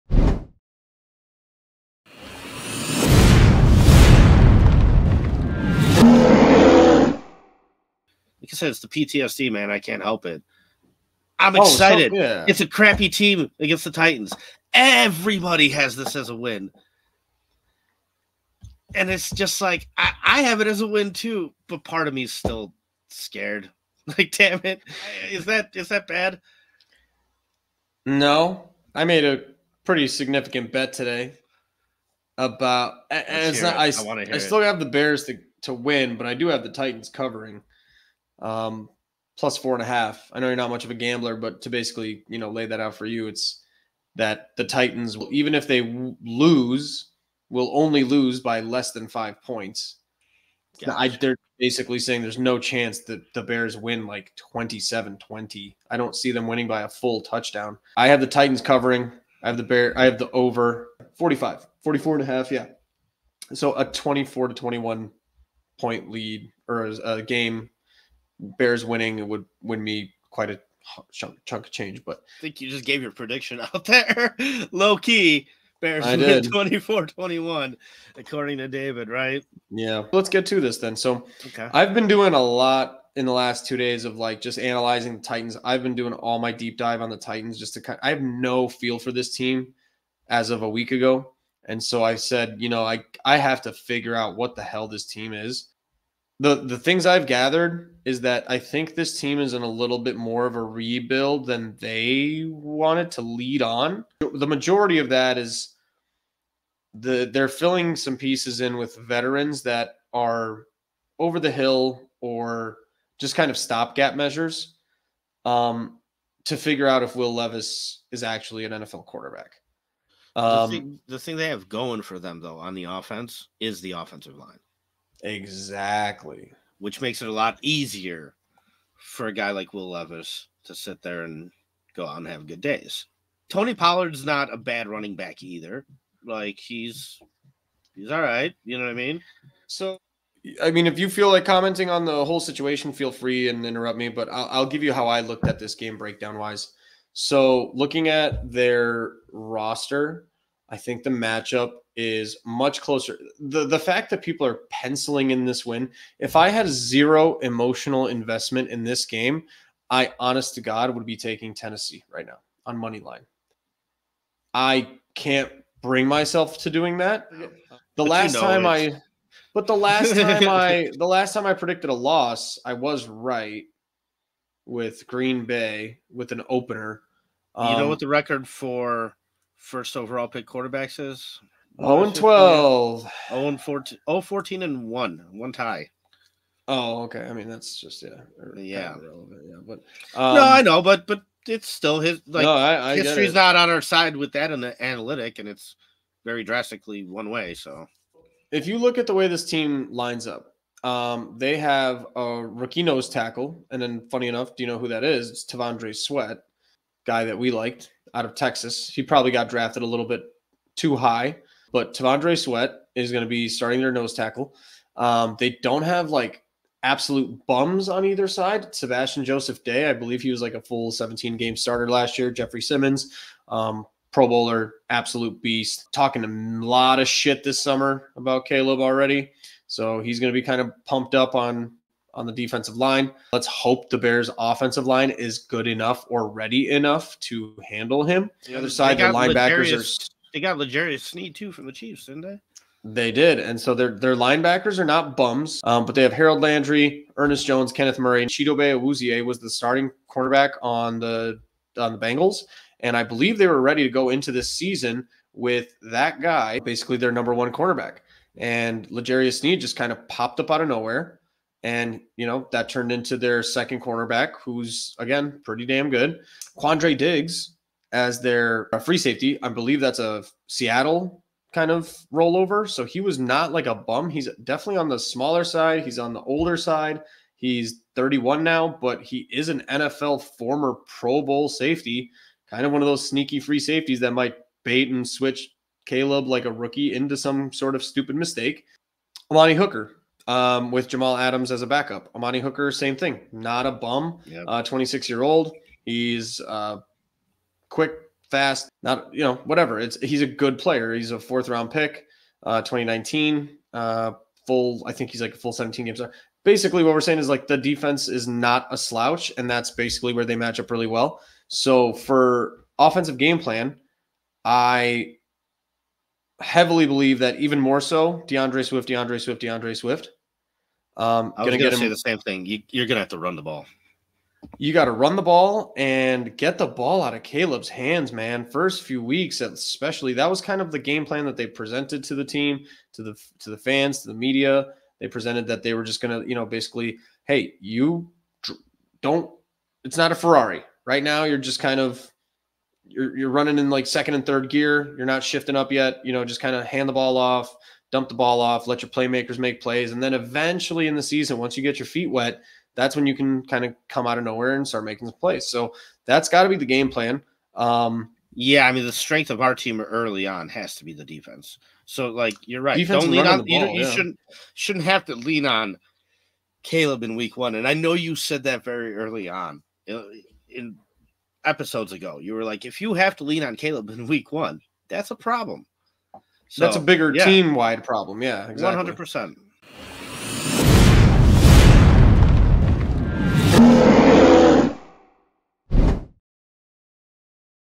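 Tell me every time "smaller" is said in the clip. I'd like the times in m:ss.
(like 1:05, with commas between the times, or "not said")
4:34.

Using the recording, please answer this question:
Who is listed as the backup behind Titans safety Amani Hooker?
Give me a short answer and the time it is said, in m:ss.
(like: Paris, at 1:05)
Jamal Adams, at 4:50.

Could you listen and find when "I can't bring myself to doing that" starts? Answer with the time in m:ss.
2:44.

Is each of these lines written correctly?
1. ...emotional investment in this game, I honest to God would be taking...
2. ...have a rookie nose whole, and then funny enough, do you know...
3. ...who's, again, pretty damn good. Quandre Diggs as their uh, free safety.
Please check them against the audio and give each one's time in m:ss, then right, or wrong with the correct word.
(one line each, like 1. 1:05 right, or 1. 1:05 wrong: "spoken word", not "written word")
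1. 2:37 right
2. 3:21 wrong: "tackle", not "whole"
3. 4:24 right.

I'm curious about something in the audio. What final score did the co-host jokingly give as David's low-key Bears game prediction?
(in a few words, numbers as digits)
24-21.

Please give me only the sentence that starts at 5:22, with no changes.
You, you're going to have to run the ball.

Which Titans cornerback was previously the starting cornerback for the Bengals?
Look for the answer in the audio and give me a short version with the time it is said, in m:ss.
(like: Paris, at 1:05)
Chidobe Awuzie, at 4:08.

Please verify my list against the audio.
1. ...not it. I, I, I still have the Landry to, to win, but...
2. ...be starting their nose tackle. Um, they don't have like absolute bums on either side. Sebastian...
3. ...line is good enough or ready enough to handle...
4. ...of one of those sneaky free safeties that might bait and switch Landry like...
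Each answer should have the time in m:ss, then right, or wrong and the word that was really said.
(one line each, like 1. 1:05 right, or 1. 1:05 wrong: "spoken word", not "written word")
1. 0:33 wrong: "Bears", not "Landry"
2. 3:33 right
3. 3:54 right
4. 4:42 wrong: "Caleb", not "Landry".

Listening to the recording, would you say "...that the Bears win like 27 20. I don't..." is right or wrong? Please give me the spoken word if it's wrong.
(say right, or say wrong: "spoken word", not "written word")
right.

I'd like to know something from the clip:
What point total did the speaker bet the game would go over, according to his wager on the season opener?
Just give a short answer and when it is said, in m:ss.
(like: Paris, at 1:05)
44.5, at 1:01.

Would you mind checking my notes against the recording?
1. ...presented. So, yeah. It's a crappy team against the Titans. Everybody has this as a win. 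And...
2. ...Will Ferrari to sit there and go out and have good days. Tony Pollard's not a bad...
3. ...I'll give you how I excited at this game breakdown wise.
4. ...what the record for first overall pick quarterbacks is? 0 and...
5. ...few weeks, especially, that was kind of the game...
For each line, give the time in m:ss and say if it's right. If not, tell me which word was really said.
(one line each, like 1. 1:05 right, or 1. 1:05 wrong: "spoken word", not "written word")
1. 0:11 wrong: "excited", not "presented"
2. 2:09 wrong: "Levis", not "Ferrari"
3. 2:24 wrong: "looked", not "excited"
4. 2:57 right
5. 5:28 right.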